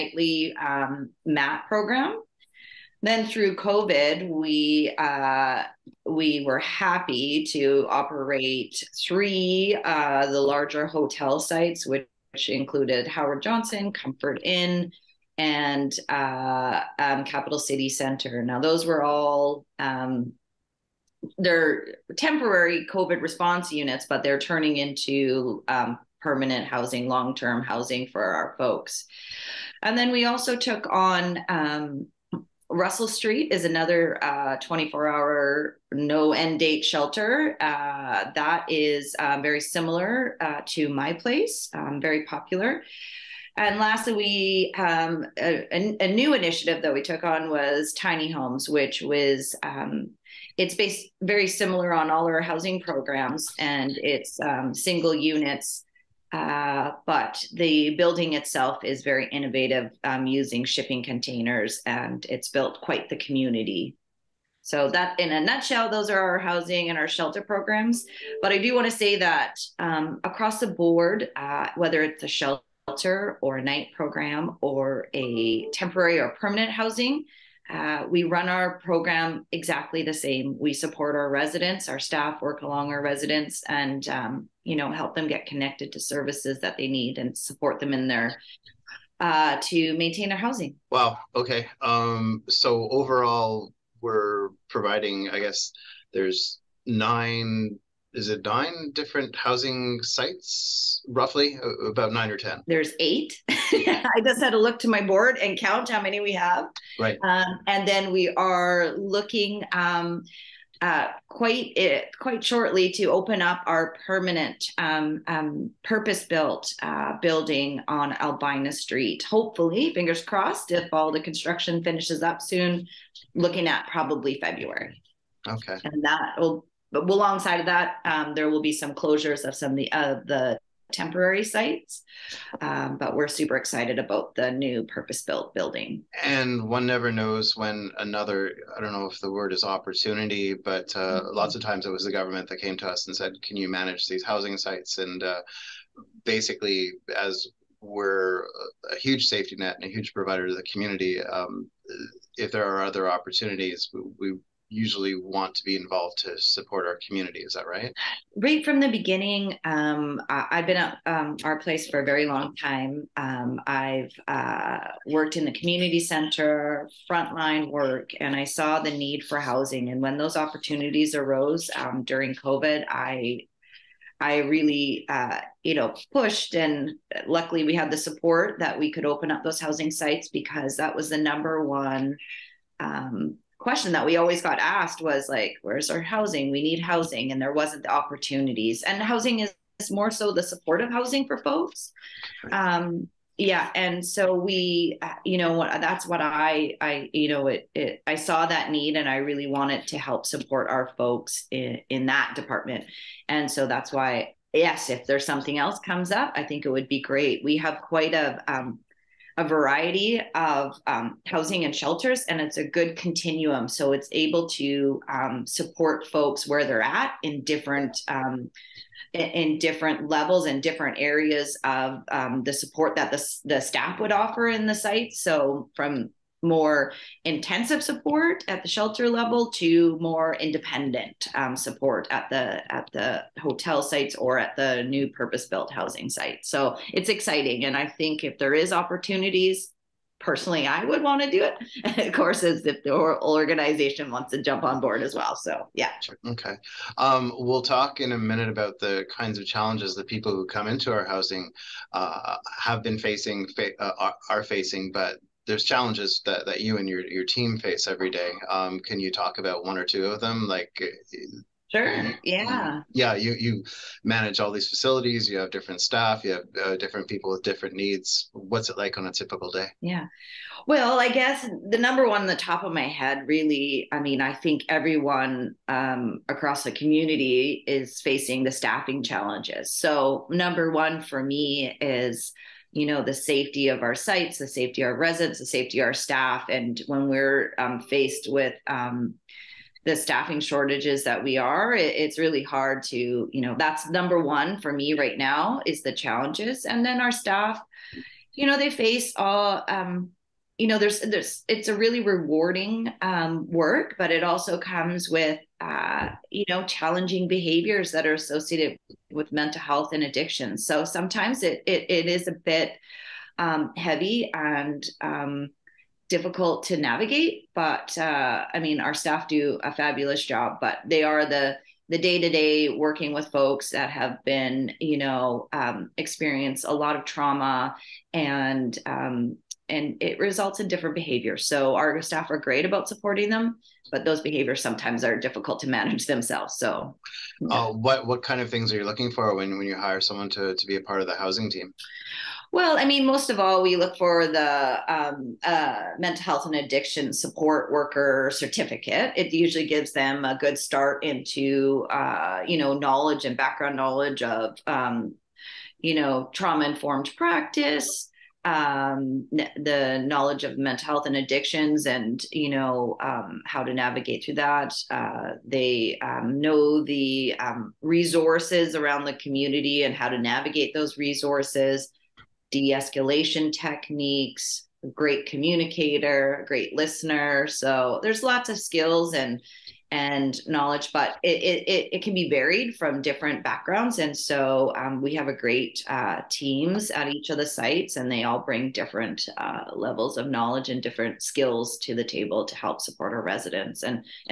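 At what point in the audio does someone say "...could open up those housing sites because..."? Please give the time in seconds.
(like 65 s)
178 s.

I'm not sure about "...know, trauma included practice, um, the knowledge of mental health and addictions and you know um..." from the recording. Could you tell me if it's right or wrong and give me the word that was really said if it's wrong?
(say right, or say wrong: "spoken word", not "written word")
wrong: "informed", not "included".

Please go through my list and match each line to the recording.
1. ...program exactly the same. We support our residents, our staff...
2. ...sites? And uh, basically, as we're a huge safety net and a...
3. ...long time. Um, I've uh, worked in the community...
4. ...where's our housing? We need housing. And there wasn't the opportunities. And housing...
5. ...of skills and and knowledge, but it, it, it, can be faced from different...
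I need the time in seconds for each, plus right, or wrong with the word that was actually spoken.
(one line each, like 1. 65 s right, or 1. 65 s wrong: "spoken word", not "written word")
1. 78 s right
2. 144 s right
3. 162 s right
4. 185 s right
5. 378 s wrong: "varied", not "faced".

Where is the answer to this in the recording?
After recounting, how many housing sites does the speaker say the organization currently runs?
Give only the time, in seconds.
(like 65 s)
102 s.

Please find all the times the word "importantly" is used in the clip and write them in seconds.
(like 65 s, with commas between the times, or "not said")
not said.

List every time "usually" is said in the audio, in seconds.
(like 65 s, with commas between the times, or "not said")
154 s, 349 s.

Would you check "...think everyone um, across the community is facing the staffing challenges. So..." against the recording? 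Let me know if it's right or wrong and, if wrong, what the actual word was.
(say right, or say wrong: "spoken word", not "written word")
right.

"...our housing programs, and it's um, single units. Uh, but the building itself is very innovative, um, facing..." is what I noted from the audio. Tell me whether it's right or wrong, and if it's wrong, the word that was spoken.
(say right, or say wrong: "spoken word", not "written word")
wrong: "using", not "facing".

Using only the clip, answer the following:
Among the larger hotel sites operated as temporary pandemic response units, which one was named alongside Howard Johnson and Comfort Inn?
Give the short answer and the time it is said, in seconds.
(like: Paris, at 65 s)
Capital City Center, at 17 s.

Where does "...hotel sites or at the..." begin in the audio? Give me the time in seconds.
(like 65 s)
233 s.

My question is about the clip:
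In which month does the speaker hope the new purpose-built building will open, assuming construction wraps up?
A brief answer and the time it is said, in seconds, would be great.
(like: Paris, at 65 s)
February, at 124 s.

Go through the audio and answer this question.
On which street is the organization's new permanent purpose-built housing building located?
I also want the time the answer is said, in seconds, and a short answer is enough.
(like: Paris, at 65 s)
Albina Street, at 118 s.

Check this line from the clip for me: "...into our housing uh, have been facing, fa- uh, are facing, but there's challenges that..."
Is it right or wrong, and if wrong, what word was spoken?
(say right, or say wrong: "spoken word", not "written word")
right.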